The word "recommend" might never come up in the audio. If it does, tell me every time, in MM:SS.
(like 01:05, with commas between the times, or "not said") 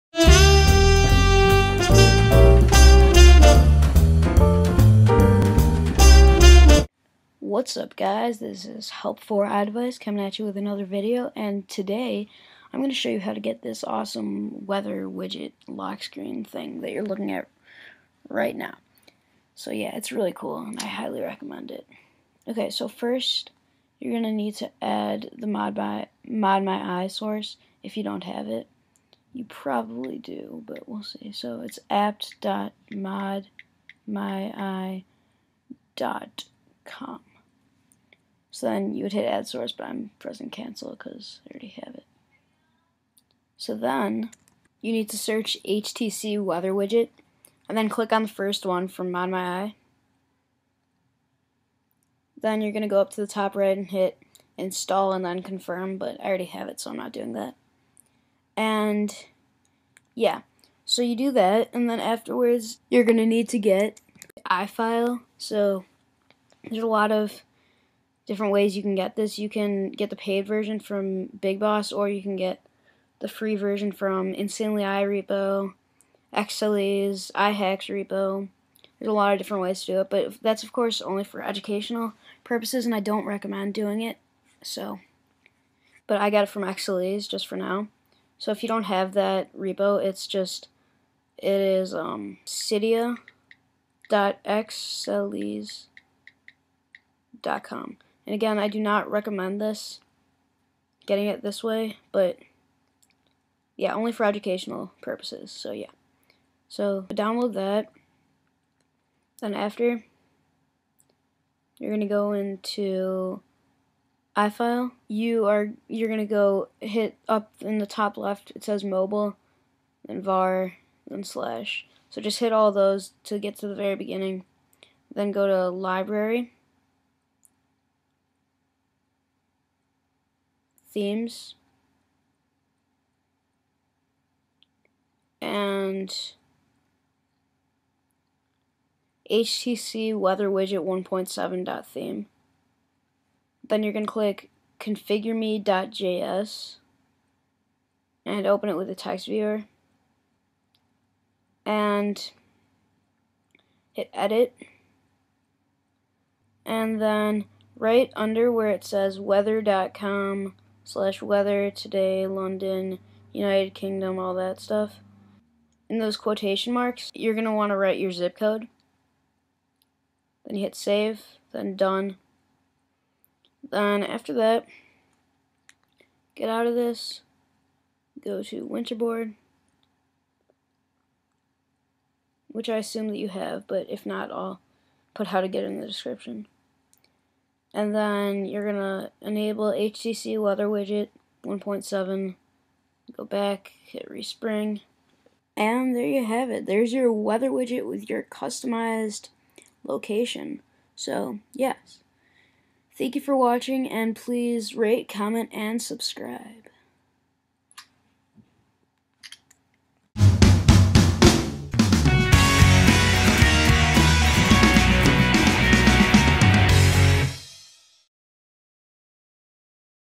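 00:21, 01:23, 01:39.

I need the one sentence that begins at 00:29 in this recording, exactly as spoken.
You probably do, but we'll see.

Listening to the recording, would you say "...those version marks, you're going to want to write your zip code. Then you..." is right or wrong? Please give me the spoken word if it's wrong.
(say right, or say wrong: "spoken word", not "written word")
wrong: "quotation", not "version".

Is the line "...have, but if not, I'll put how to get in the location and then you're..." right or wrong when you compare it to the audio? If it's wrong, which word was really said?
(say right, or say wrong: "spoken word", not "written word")
wrong: "description", not "location".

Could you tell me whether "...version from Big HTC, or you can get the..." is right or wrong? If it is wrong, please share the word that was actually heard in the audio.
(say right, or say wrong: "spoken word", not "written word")
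wrong: "Boss", not "HTC".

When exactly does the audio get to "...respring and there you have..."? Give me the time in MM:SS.
03:14.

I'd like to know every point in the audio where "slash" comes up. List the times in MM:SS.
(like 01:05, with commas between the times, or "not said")
02:01, 02:40.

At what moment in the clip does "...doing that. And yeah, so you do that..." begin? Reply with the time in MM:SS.
00:57.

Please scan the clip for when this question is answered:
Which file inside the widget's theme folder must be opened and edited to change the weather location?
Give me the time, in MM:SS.
02:24.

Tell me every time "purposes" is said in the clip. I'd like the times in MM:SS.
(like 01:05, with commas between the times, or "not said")
01:22, 01:45.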